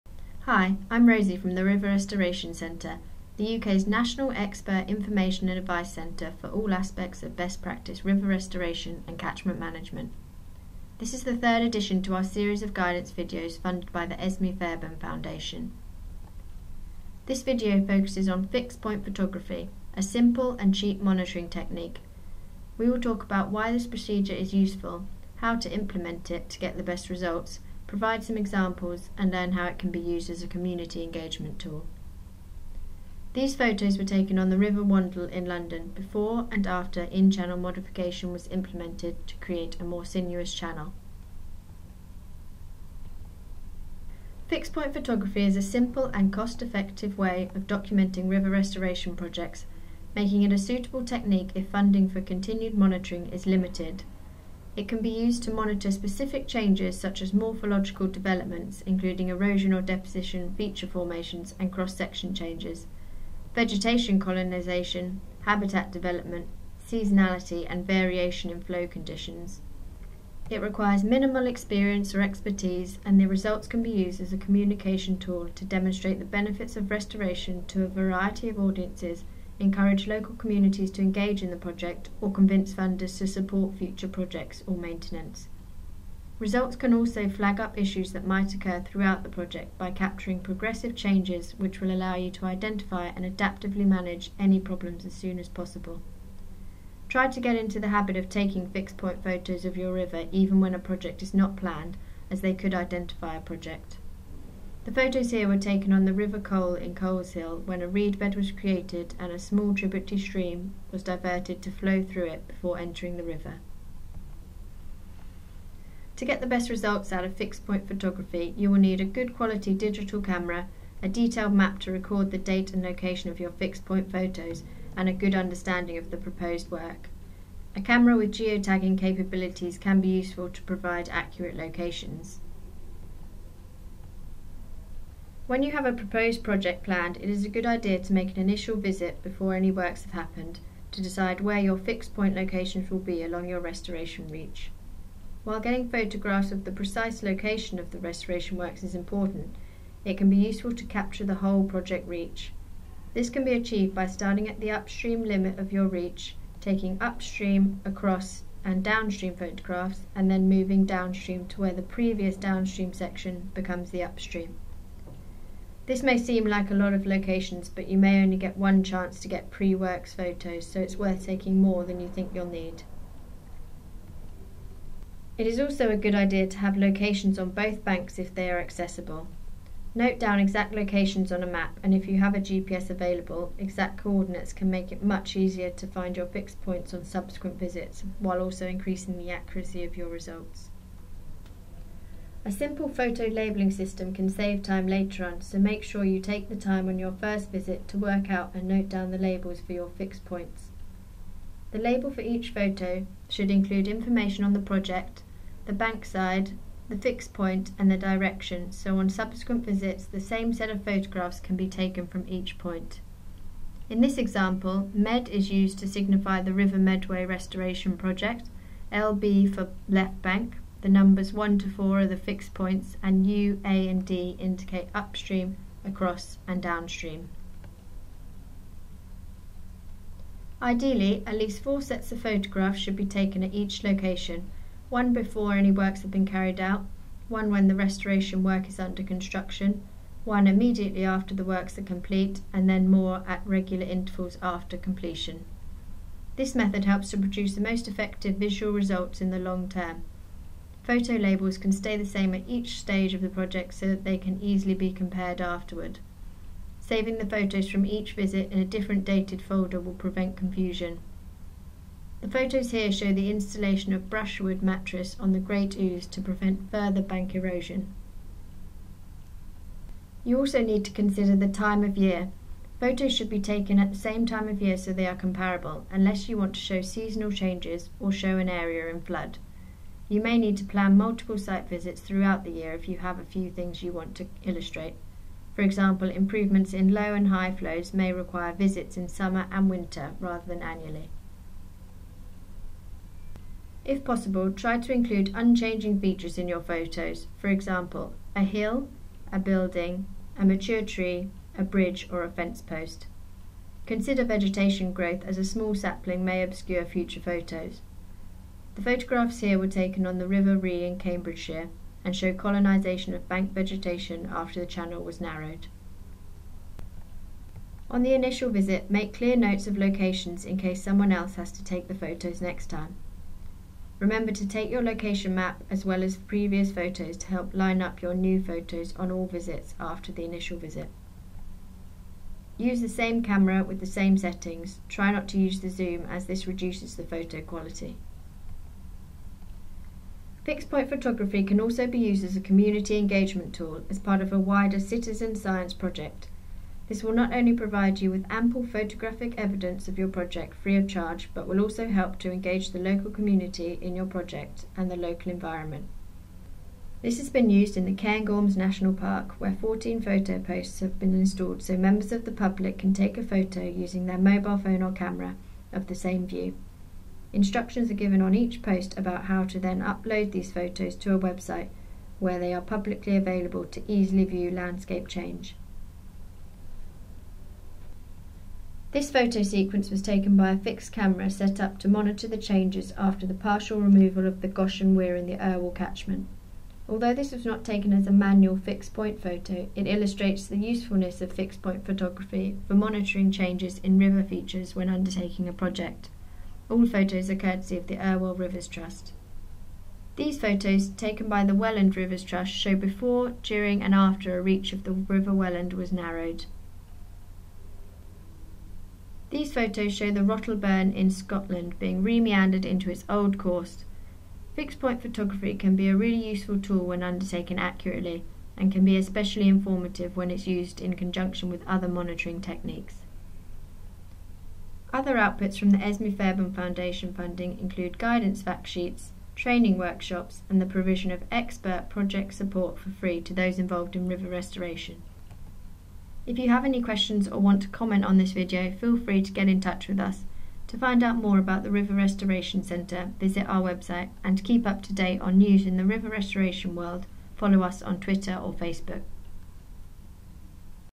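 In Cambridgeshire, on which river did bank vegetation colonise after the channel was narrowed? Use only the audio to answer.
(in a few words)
River Rhee.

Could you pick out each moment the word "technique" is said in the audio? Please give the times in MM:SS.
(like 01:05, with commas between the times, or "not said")
00:21, 00:51, 07:02.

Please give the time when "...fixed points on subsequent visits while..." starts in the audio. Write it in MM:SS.
03:06.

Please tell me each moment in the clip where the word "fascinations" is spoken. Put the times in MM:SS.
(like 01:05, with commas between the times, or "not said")
not said.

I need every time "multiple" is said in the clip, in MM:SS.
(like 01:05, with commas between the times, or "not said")
04:40.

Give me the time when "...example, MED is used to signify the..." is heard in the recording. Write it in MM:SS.
03:34.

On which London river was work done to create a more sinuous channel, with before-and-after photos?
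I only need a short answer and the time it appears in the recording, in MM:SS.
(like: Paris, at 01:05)
River Wandle, at 00:34.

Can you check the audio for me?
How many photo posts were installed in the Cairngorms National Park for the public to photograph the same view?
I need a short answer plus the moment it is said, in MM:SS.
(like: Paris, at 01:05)
14, at 05:59.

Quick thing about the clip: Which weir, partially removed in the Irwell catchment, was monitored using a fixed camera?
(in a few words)
Goshen Weir.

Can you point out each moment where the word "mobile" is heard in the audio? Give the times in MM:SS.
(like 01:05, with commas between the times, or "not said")
06:04.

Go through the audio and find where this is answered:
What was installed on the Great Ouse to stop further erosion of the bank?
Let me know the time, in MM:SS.
04:24.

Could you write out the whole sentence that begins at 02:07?
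A camera with geotagging capabilities can be useful to provide accurate locations.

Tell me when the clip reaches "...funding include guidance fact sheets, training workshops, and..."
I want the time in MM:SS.
07:07.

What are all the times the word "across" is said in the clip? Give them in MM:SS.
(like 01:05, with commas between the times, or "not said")
02:37, 03:45.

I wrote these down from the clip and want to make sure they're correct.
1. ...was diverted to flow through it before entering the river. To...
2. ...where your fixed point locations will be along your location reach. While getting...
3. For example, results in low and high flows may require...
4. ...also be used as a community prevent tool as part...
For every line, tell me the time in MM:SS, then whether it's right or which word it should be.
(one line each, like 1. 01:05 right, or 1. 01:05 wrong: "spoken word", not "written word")
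1. 01:50 right
2. 02:21 wrong: "restoration", not "location"
3. 04:45 wrong: "improvements", not "results"
4. 05:41 wrong: "engagement", not "prevent".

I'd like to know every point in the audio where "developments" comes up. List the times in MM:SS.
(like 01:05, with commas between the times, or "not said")
00:58, 01:05.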